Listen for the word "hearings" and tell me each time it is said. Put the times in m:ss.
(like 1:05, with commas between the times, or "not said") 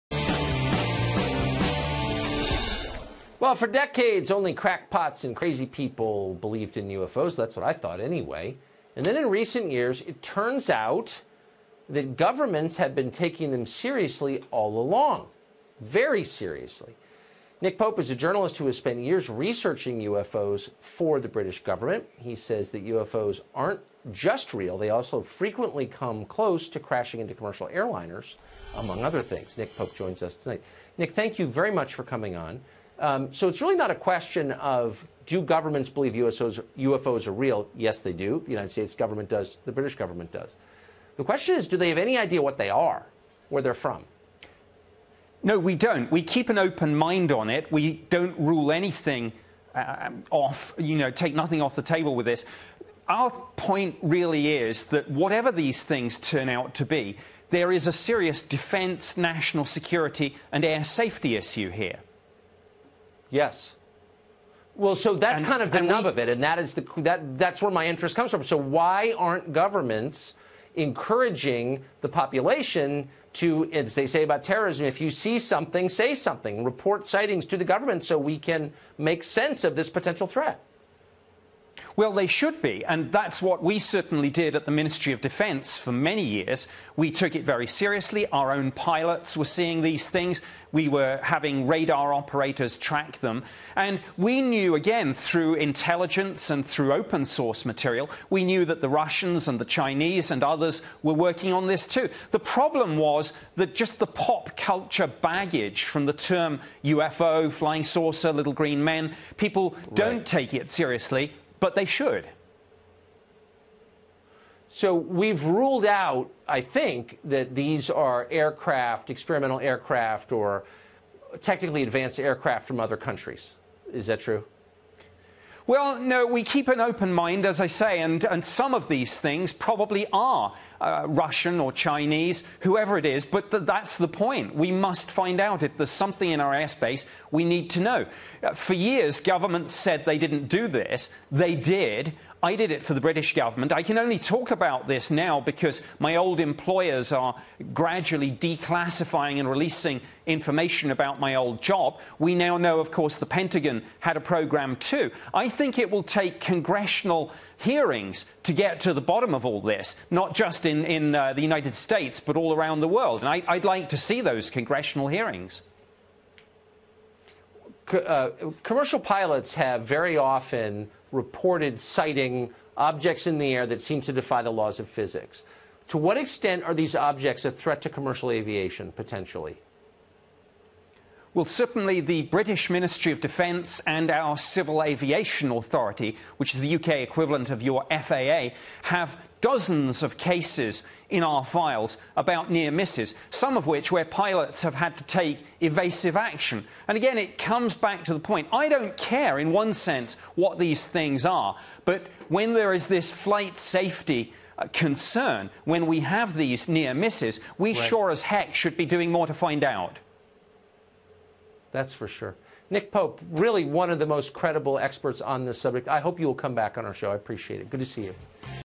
2:37, 2:45.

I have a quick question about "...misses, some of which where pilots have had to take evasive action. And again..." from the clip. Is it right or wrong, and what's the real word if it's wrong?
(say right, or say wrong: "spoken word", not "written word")
right.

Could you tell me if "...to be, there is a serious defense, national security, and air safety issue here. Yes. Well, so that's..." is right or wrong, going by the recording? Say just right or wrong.
right.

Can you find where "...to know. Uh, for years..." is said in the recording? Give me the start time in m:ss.
2:17.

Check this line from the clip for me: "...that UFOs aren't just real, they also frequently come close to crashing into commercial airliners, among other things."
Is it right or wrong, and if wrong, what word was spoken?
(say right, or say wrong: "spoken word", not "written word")
right.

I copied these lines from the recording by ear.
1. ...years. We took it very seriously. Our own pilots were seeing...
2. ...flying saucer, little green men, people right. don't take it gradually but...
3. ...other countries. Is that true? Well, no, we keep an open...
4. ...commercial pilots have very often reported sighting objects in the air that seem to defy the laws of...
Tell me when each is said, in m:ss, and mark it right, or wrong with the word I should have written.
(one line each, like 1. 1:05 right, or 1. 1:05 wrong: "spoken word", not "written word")
1. 1:26 right
2. 1:47 wrong: "seriously", not "gradually"
3. 2:02 right
4. 2:48 right.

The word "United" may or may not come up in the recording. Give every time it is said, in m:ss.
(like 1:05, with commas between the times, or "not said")
0:38, 2:41.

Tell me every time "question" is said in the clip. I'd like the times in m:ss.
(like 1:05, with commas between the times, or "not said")
0:33, 0:41.